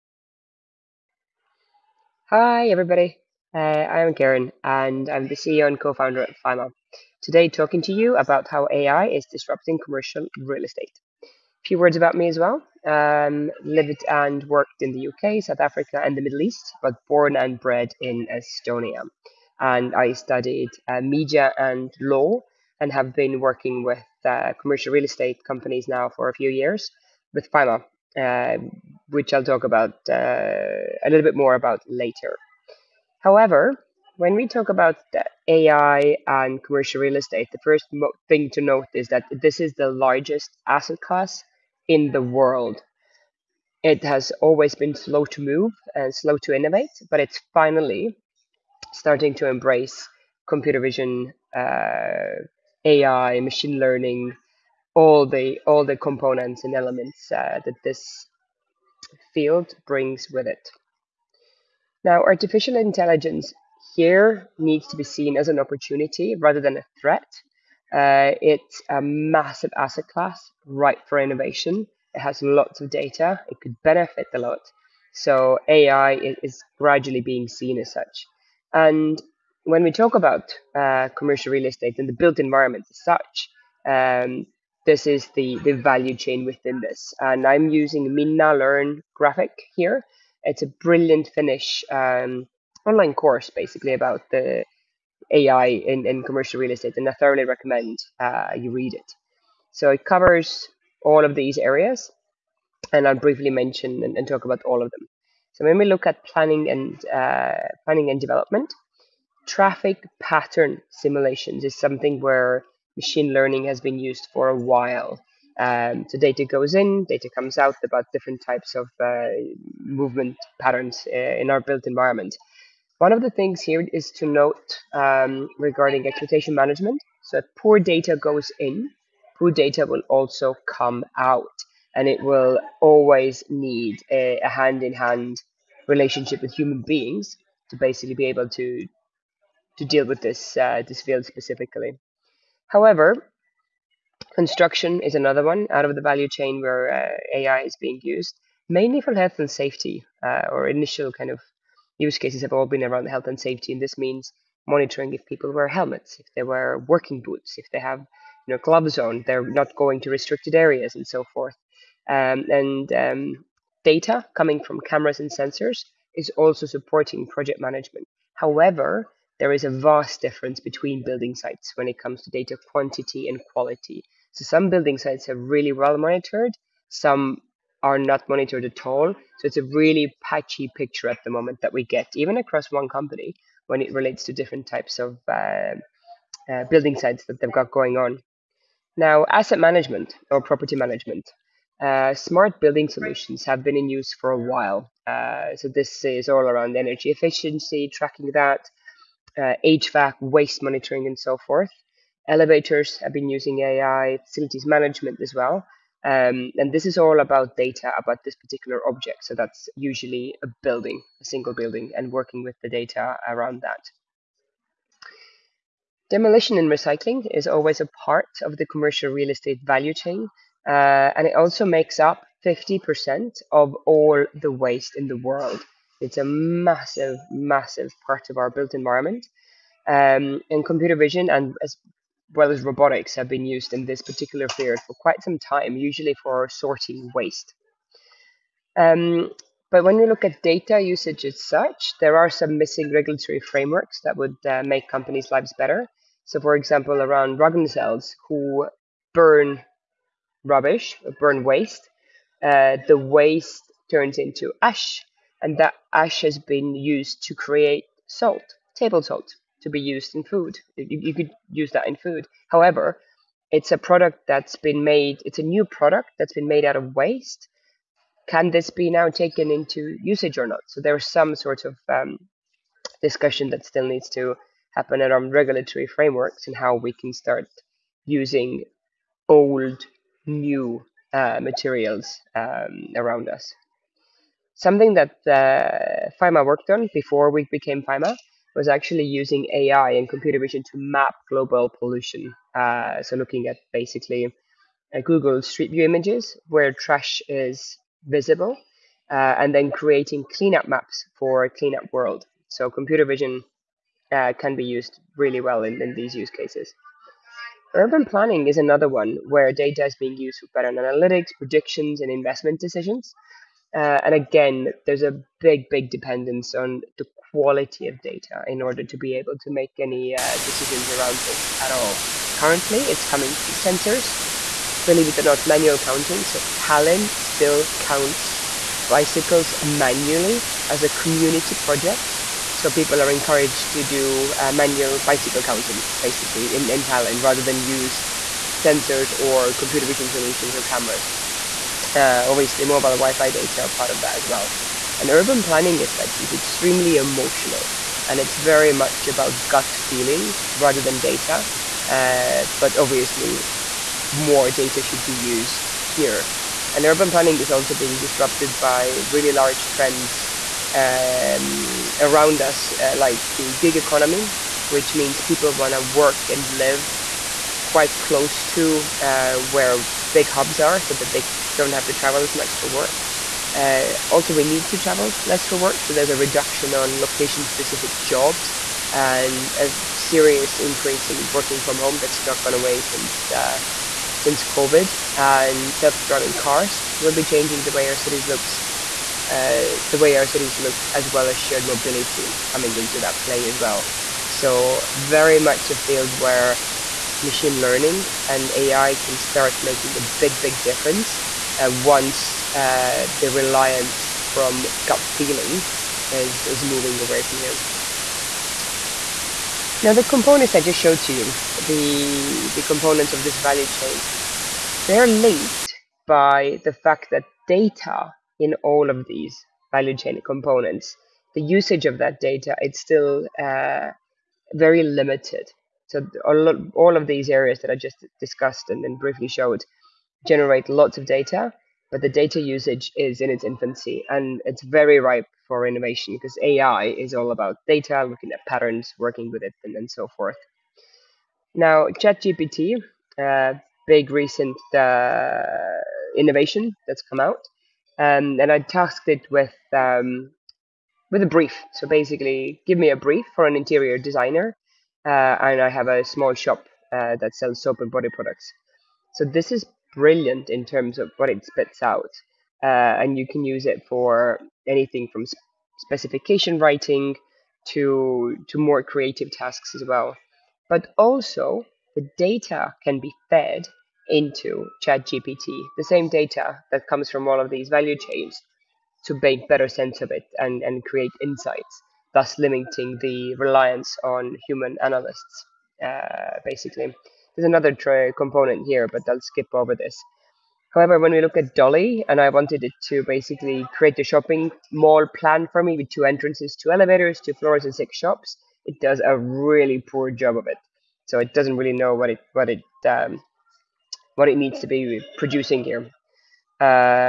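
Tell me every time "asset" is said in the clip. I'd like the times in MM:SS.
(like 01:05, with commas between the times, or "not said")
00:40, 01:09, 03:09.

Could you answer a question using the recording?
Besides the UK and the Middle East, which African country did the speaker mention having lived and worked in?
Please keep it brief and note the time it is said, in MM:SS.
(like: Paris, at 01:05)
South Africa, at 00:15.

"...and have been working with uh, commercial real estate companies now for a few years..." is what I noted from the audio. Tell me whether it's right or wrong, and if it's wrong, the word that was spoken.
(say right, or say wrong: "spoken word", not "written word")
right.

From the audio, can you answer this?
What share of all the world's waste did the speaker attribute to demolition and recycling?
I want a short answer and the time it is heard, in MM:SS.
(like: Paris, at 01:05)
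50%, at 03:42.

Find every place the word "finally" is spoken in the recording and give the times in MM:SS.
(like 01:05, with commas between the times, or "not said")
00:47.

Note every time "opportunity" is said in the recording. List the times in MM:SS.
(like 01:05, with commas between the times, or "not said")
01:05.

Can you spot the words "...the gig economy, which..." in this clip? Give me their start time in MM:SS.
06:03.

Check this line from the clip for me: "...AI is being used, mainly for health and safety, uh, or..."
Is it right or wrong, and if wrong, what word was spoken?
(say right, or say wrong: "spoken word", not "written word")
right.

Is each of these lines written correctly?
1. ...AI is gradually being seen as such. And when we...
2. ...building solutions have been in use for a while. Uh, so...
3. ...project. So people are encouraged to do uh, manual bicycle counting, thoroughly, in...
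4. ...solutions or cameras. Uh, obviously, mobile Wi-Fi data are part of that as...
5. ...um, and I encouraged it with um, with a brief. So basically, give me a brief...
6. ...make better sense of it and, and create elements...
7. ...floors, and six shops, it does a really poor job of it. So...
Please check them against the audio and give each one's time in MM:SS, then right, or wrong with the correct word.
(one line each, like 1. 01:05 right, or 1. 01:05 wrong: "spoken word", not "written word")
1. 01:15 right
2. 03:12 right
3. 05:31 wrong: "basically", not "thoroughly"
4. 05:40 right
5. 07:27 wrong: "tasked", not "encouraged"
6. 07:59 wrong: "insights", not "elements"
7. 08:17 right.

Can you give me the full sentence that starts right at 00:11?
A few words about me as well.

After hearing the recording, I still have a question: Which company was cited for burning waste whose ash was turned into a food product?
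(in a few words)
Ragn-Sells.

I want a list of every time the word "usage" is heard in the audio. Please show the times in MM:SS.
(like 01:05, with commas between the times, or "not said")
04:00, 04:30, 07:01, 07:12.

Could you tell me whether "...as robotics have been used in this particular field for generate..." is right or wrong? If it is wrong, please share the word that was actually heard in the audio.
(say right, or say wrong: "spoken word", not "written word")
wrong: "quite", not "generate".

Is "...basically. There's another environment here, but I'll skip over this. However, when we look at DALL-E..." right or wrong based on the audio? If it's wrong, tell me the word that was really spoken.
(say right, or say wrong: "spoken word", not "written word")
wrong: "component", not "environment".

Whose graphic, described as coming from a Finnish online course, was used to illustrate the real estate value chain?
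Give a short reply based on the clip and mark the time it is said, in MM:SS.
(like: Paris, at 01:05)
MinnaLearn, at 01:28.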